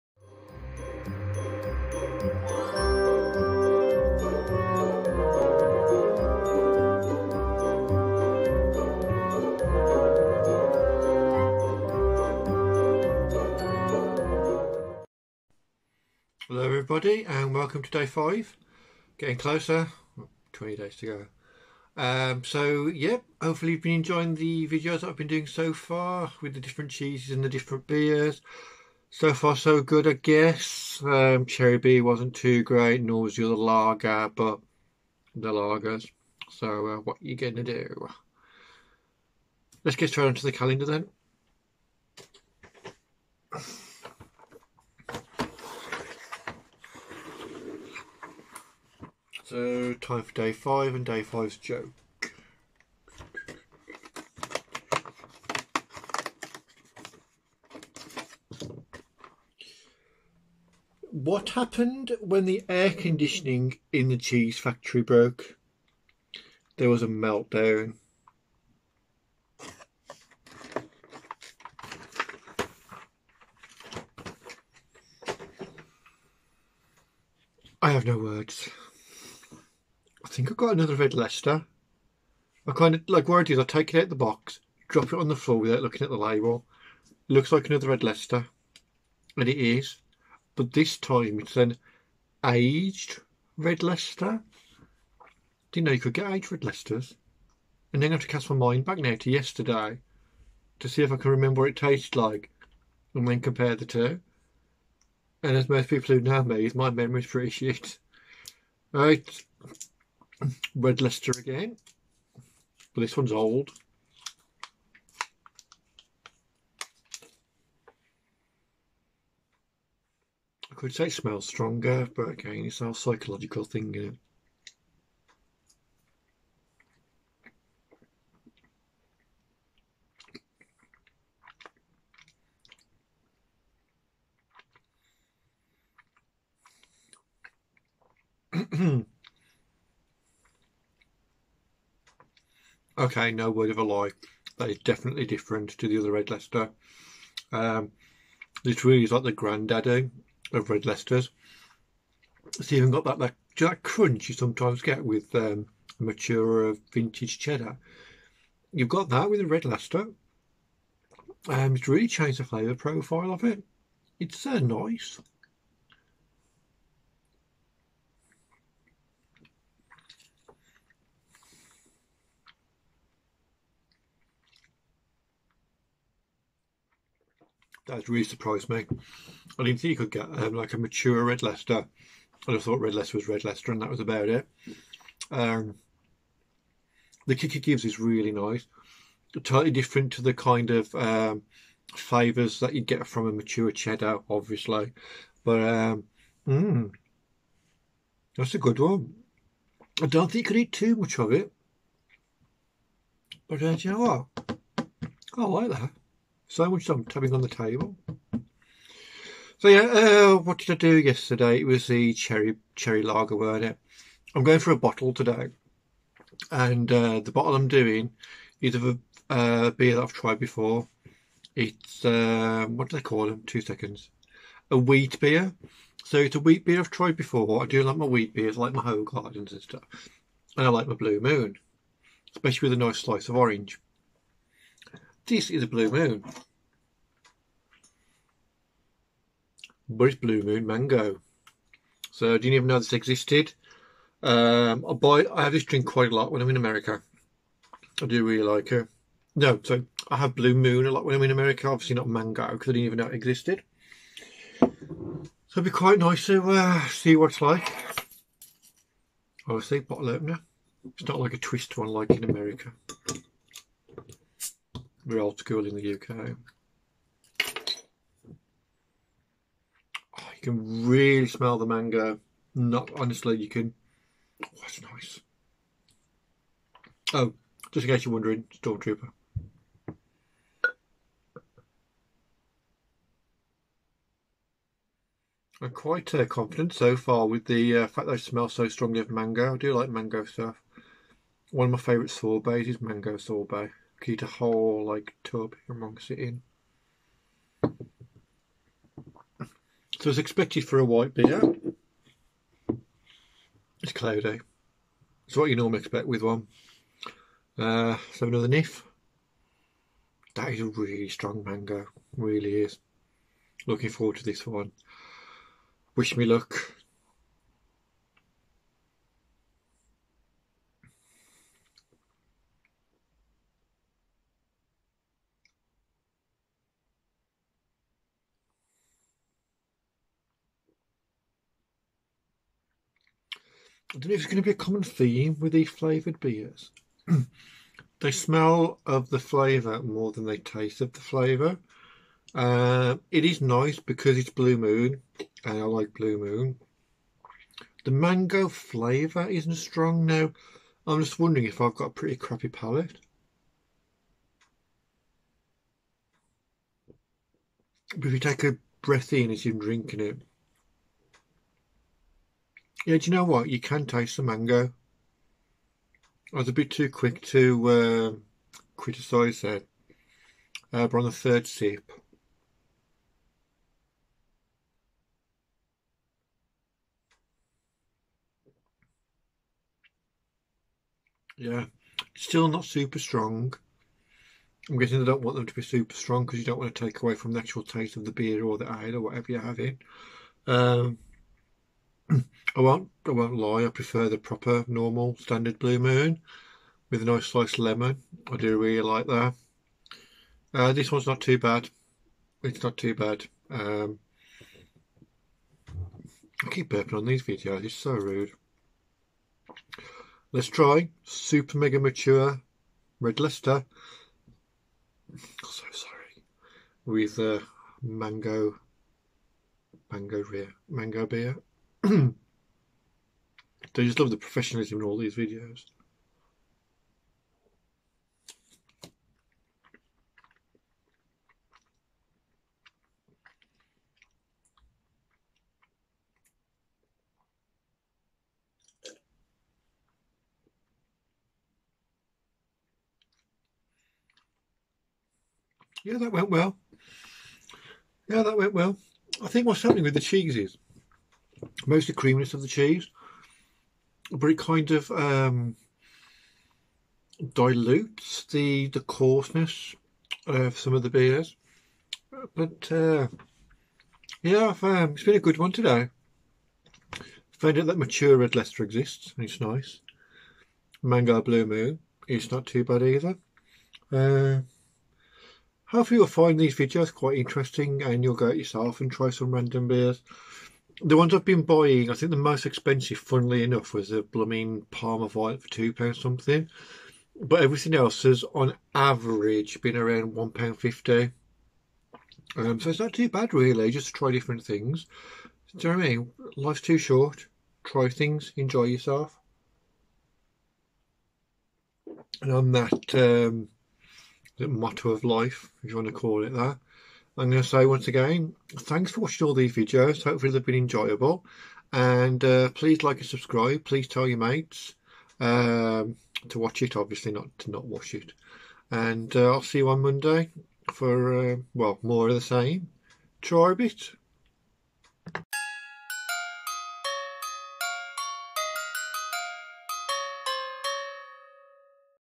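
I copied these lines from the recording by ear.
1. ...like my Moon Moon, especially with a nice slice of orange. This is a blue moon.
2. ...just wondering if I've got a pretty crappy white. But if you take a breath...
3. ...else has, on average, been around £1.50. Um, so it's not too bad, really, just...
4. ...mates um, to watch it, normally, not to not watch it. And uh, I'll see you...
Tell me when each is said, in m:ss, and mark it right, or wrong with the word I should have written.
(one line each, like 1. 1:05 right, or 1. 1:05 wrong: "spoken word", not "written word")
1. 3:50 wrong: "Blue", not "Moon"
2. 5:51 wrong: "palate", not "white"
3. 8:07 right
4. 8:34 wrong: "obviously", not "normally".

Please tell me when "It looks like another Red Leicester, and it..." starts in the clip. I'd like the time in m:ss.
1:27.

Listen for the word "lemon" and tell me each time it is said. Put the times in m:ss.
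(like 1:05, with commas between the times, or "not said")
6:37.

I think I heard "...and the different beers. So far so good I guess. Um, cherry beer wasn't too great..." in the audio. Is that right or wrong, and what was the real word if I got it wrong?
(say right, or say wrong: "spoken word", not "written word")
right.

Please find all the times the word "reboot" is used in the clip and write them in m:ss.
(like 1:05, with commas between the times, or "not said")
not said.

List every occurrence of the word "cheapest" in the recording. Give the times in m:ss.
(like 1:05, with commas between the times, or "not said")
not said.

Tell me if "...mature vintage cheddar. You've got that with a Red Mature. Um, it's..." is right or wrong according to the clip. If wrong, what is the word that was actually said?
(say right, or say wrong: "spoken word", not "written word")
wrong: "Leicester", not "Mature".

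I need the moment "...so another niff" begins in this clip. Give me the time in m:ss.
5:08.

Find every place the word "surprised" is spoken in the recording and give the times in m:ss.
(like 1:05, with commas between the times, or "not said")
2:58.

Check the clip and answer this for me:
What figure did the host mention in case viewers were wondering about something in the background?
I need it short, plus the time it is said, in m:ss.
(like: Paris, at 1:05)
Stormtrooper, at 4:38.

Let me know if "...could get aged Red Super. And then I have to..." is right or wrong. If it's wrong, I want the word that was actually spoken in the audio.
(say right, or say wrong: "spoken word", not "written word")
wrong: "Leicesters", not "Super".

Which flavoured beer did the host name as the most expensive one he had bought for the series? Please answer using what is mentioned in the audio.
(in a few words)
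Parma Violet.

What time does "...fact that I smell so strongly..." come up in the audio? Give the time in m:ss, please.
4:47.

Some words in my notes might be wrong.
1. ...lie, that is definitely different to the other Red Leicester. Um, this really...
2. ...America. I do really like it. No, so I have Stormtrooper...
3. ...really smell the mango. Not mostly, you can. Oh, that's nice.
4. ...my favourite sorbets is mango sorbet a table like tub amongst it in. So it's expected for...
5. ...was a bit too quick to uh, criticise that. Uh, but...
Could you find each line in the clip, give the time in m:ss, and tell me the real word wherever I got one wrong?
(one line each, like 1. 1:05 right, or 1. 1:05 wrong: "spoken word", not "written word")
1. 2:23 right
2. 4:06 wrong: "Blue", not "Stormtrooper"
3. 4:30 wrong: "honestly", not "mostly"
4. 4:51 wrong: "whole", not "table"
5. 6:06 right.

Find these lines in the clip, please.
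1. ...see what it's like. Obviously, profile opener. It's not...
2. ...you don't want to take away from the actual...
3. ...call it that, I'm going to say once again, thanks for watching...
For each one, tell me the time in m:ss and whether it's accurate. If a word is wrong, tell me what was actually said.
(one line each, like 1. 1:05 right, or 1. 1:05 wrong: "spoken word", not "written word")
1. 4:16 wrong: "bottle", not "profile"
2. 6:26 right
3. 8:25 right.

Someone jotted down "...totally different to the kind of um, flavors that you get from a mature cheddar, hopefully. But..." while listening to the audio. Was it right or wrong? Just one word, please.
wrong.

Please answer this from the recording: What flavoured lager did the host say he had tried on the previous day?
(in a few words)
Cherry lager.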